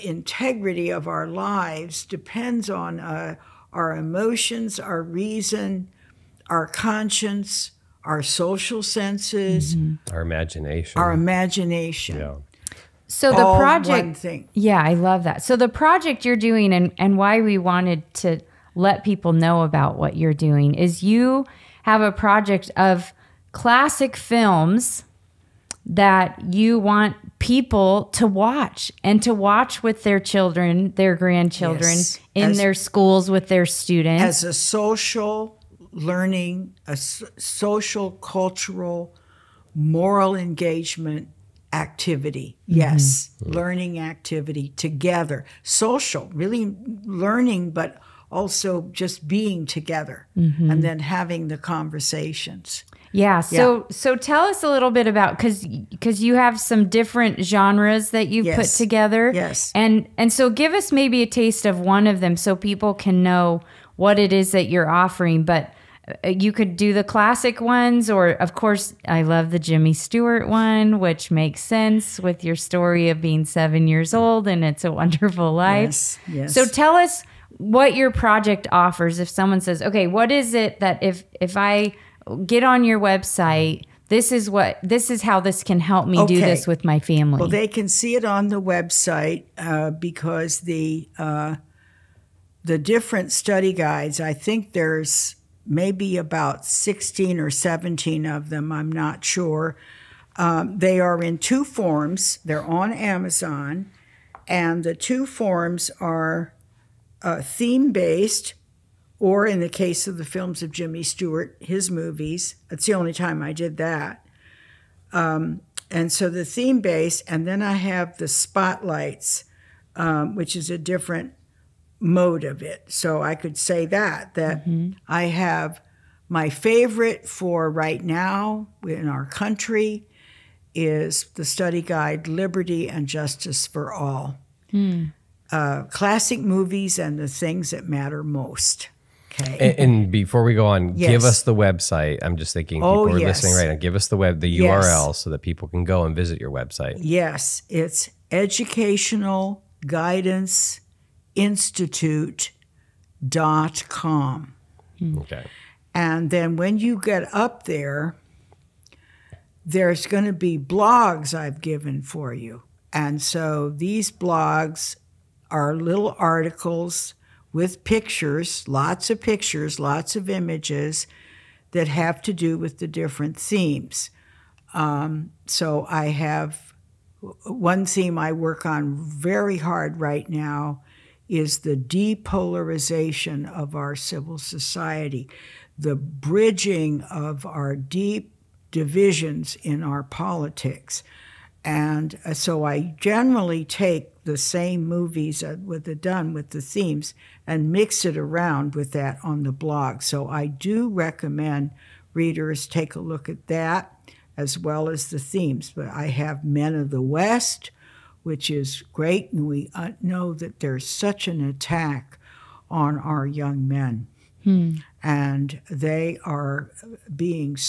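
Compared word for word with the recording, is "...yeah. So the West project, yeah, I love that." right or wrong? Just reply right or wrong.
wrong.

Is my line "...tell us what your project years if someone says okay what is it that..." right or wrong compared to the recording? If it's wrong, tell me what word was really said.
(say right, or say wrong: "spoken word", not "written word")
wrong: "offers", not "years".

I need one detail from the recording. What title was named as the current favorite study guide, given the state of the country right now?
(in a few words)
Liberty and Justice for All.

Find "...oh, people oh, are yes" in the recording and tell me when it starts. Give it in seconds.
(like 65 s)
142 s.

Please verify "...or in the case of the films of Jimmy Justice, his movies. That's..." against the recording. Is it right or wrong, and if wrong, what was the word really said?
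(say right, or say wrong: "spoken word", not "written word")
wrong: "Stewart", not "Justice".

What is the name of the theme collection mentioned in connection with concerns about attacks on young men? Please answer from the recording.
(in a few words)
Men of the West.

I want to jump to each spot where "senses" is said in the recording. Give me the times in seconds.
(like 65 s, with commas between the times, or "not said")
8 s, 71 s.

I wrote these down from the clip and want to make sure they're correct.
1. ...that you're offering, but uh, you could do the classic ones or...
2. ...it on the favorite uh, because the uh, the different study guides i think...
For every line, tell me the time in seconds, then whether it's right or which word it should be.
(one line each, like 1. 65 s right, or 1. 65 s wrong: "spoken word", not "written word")
1. 64 s right
2. 88 s wrong: "website", not "favorite".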